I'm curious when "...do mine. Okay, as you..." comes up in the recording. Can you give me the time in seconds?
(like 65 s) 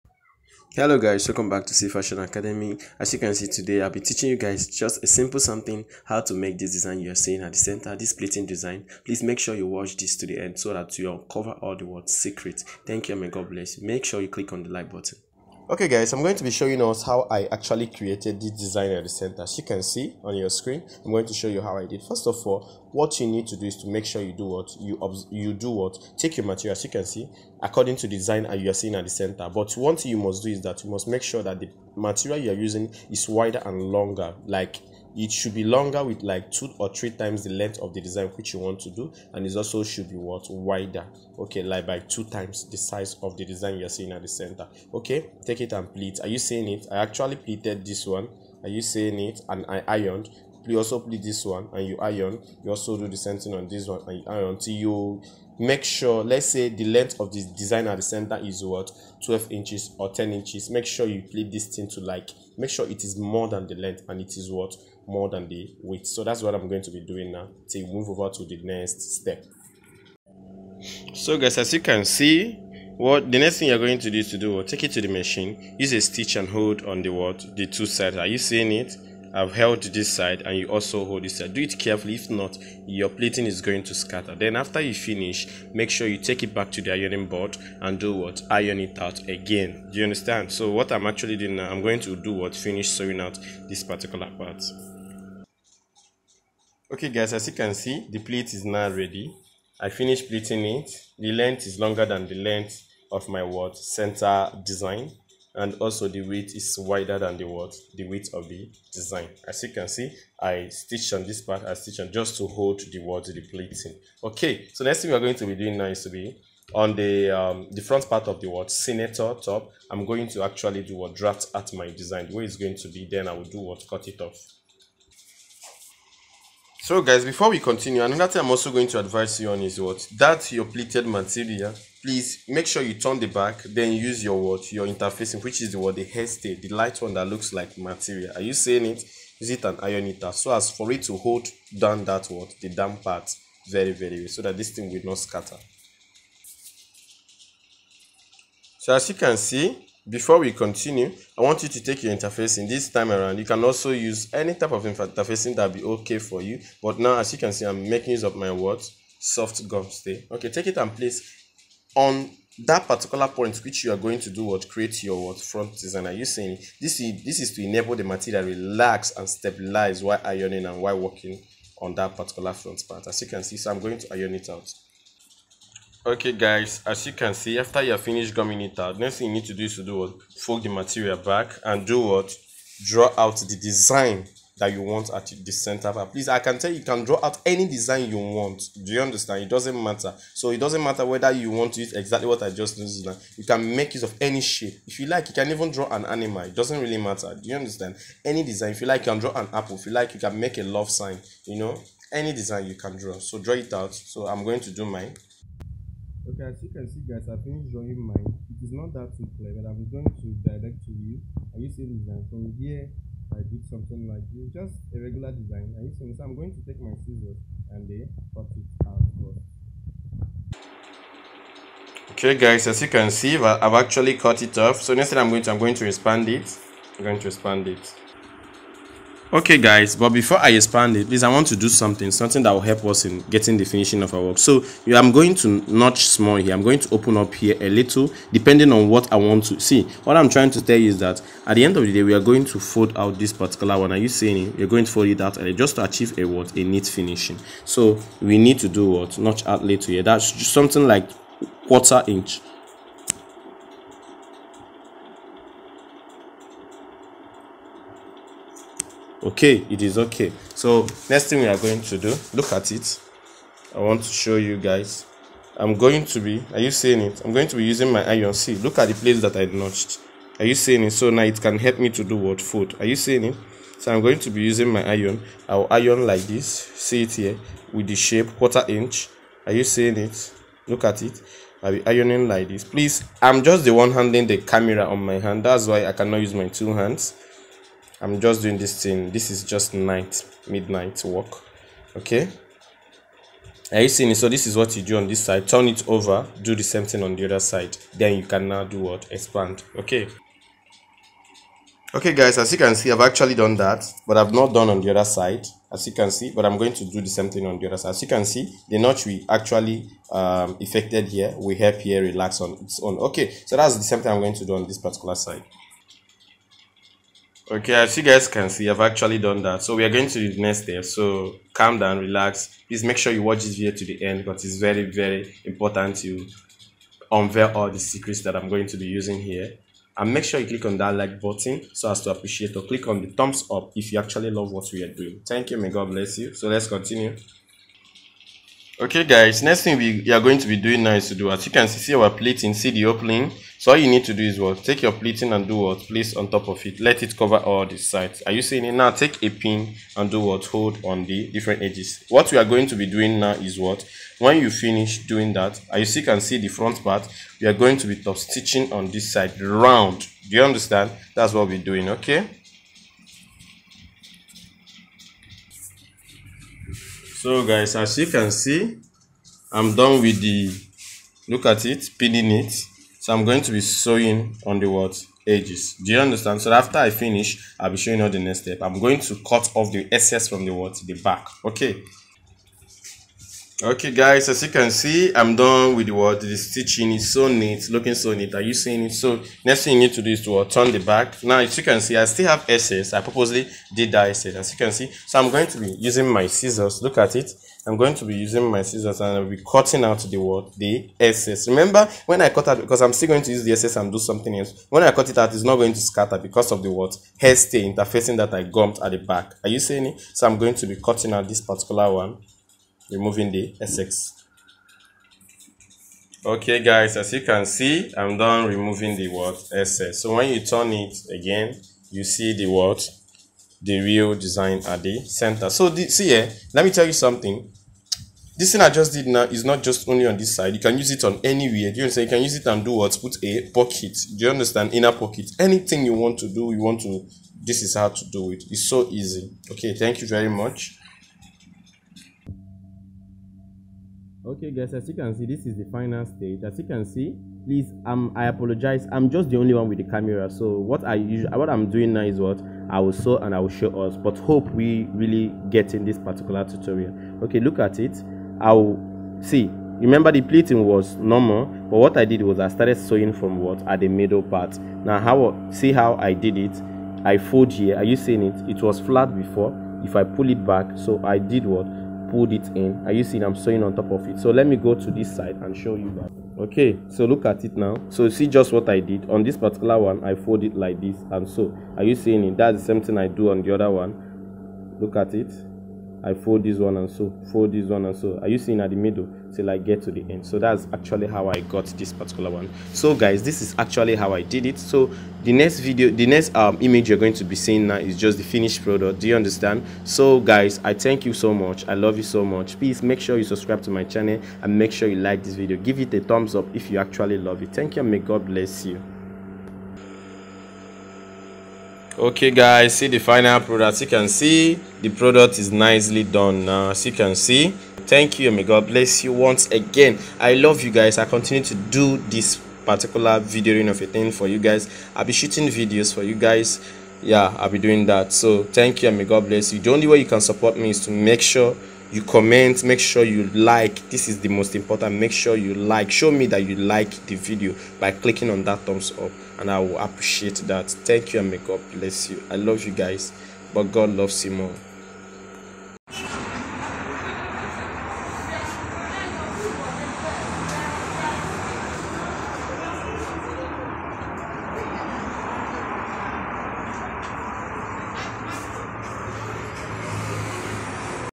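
204 s.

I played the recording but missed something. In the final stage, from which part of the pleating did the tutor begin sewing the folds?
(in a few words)
The middle part.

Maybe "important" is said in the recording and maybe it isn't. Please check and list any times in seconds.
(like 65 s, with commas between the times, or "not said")
325 s, 534 s.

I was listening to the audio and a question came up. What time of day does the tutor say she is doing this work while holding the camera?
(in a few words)
Midnight.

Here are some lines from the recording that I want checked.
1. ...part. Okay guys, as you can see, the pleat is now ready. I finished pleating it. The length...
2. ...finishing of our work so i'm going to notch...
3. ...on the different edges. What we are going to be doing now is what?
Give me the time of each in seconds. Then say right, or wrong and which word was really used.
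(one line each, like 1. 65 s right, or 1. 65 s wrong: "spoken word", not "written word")
1. 94 s right
2. 233 s right
3. 350 s right.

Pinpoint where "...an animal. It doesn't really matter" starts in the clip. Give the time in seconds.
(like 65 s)
195 s.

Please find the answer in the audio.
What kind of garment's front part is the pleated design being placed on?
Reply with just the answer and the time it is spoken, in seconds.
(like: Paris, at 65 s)
Senator top, at 118 s.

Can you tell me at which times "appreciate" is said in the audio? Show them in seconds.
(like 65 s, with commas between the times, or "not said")
332 s, 539 s.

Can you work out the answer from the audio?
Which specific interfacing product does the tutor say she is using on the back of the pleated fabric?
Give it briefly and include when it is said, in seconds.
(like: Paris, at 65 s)
Soft gum stay, at 159 s.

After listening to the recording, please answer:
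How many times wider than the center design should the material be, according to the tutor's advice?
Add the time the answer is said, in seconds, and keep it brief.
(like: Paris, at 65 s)
2 times, at 41 s.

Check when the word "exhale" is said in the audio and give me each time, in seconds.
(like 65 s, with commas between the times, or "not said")
not said.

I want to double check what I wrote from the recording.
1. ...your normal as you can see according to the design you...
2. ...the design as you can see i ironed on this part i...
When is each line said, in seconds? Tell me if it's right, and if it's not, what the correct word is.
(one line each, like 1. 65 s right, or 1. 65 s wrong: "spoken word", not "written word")
1. 26 s wrong: "material", not "normal"
2. 108 s wrong: "stitched", not "ironed".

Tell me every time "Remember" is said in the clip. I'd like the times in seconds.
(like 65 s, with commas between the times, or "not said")
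401 s, 459 s.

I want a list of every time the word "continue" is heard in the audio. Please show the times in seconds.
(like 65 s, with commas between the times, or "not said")
127 s, 150 s, 336 s, 521 s.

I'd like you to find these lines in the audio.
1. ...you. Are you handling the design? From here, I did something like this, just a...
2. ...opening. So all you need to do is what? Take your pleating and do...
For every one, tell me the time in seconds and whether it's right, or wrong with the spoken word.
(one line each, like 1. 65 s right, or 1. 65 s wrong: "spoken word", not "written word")
1. 210 s wrong: "seeing", not "handling"
2. 342 s right.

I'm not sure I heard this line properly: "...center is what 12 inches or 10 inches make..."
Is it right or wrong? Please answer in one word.
right.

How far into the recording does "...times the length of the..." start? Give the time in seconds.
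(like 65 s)
37 s.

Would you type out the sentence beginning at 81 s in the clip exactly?
Do it carefully, if not, your pleating is going to scatter.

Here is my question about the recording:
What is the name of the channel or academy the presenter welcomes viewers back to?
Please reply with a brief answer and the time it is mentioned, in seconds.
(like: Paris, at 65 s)
Cee Fashion Academy, at 1 s.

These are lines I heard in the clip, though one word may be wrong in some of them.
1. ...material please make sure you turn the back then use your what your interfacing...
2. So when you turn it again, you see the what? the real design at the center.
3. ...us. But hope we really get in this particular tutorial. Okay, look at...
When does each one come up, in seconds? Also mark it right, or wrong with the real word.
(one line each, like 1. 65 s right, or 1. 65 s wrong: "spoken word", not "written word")
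1. 131 s right
2. 420 s right
3. 453 s right.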